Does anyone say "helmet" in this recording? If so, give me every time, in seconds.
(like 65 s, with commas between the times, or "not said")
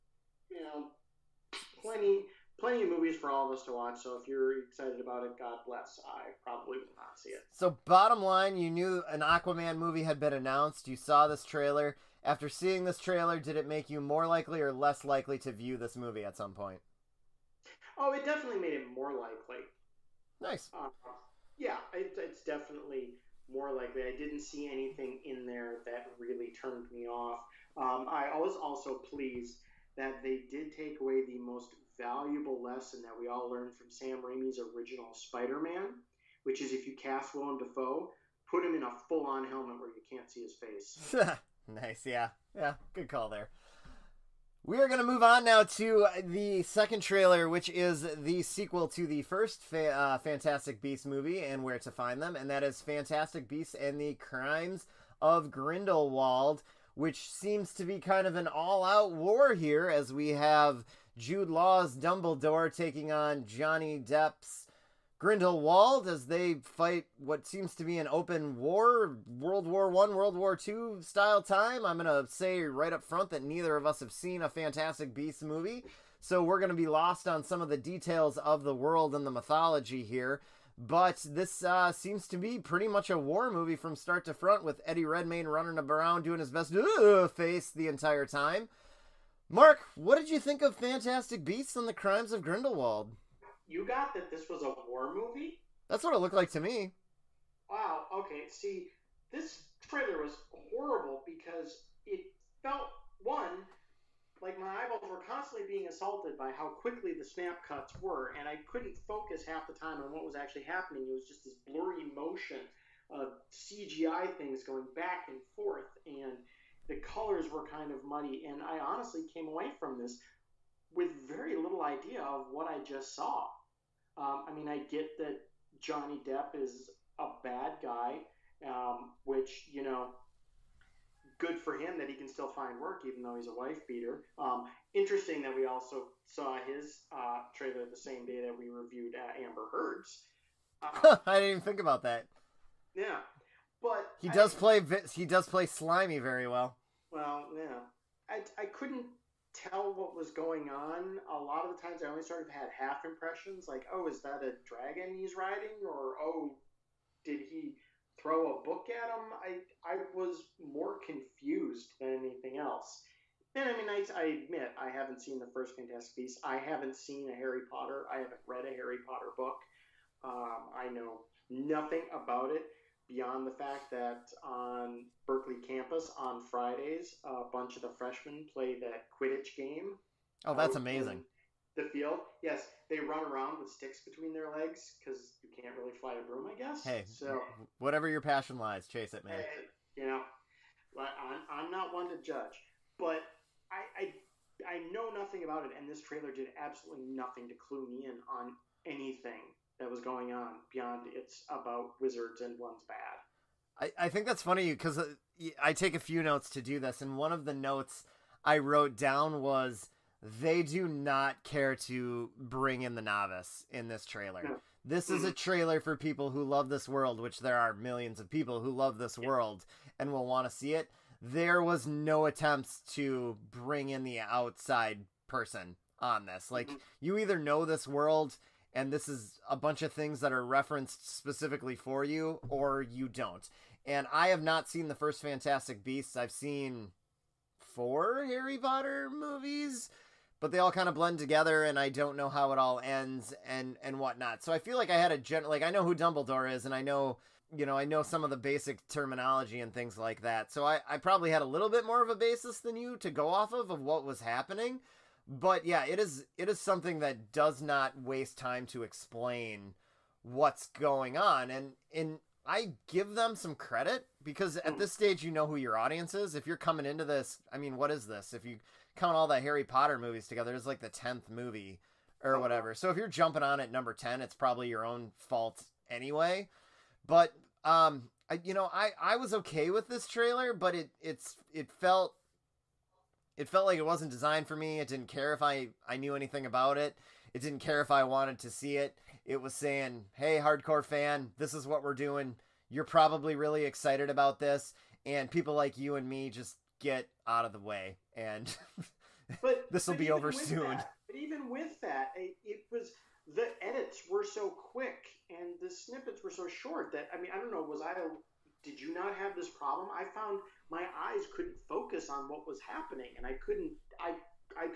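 39 s.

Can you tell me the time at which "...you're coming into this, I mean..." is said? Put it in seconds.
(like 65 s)
266 s.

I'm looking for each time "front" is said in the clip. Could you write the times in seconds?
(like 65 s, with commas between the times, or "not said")
73 s, 84 s.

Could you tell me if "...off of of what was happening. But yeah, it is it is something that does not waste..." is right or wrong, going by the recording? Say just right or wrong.
right.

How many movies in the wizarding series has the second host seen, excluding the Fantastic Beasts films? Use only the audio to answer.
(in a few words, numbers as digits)
4.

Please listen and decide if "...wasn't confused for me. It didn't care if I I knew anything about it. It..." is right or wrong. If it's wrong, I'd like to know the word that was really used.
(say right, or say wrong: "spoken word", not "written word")
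wrong: "designed", not "confused".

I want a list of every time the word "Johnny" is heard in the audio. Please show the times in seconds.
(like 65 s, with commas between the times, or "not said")
63 s, 125 s.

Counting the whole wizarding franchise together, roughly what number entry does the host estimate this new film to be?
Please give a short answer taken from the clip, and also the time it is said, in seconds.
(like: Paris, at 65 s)
10, at 270 s.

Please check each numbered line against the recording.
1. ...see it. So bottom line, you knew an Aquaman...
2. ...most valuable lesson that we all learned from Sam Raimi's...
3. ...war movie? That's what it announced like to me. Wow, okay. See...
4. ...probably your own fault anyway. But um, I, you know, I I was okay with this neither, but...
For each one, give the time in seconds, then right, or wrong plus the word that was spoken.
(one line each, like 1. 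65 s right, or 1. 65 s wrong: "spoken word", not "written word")
1. 7 s right
2. 31 s right
3. 94 s wrong: "looked", not "announced"
4. 274 s wrong: "trailer", not "neither".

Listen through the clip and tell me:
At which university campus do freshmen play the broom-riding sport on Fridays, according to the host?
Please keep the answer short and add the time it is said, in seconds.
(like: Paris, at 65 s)
Berkeley, at 175 s.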